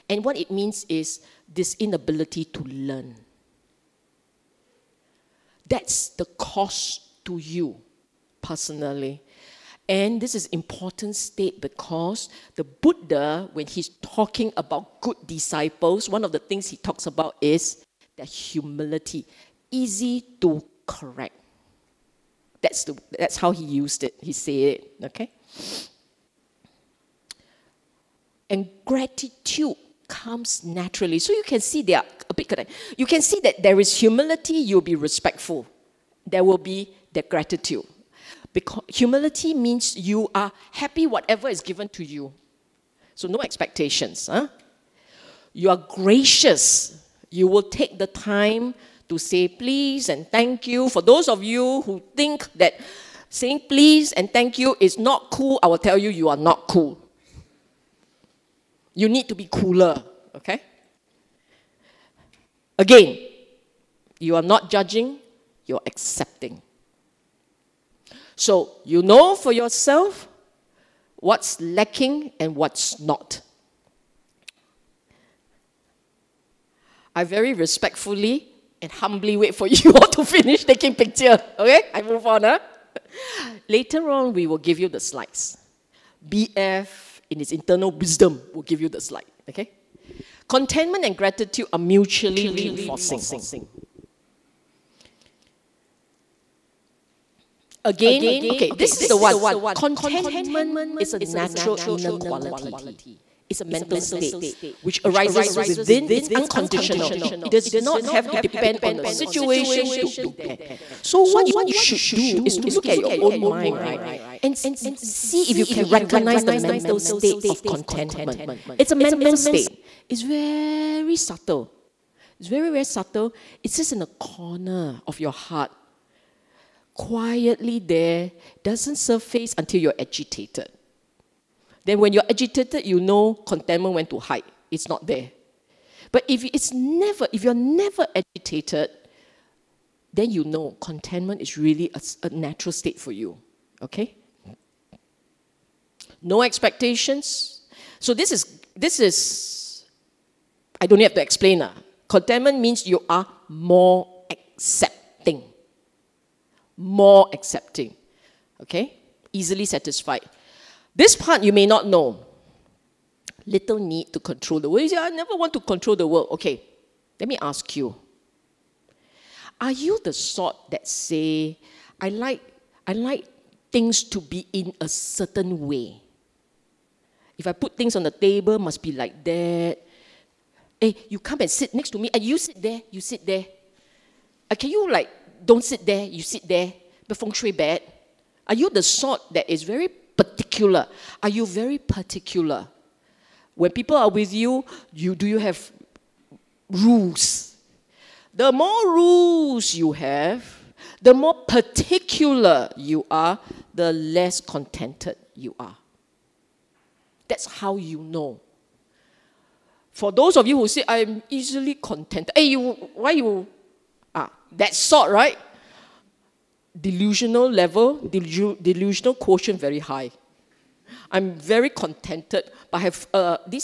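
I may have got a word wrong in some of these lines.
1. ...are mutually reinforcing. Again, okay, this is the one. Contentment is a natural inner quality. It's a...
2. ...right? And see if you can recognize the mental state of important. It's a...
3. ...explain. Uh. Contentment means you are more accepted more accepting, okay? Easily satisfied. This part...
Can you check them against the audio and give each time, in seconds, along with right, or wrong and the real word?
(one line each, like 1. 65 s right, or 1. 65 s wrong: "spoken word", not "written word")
1. 91 s right
2. 113 s wrong: "contentment", not "important"
3. 151 s right.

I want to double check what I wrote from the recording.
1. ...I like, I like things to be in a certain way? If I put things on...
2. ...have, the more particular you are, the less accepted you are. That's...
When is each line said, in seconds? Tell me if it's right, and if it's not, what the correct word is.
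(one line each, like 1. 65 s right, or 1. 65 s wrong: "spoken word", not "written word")
1. 171 s right
2. 199 s wrong: "contented", not "accepted".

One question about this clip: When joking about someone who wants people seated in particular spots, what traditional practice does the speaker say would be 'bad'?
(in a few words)
feng shui.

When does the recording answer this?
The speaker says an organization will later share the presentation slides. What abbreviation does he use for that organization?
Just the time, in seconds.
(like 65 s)
86 s.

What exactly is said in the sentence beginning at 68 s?
So you know for yourself what's lacking and what's not.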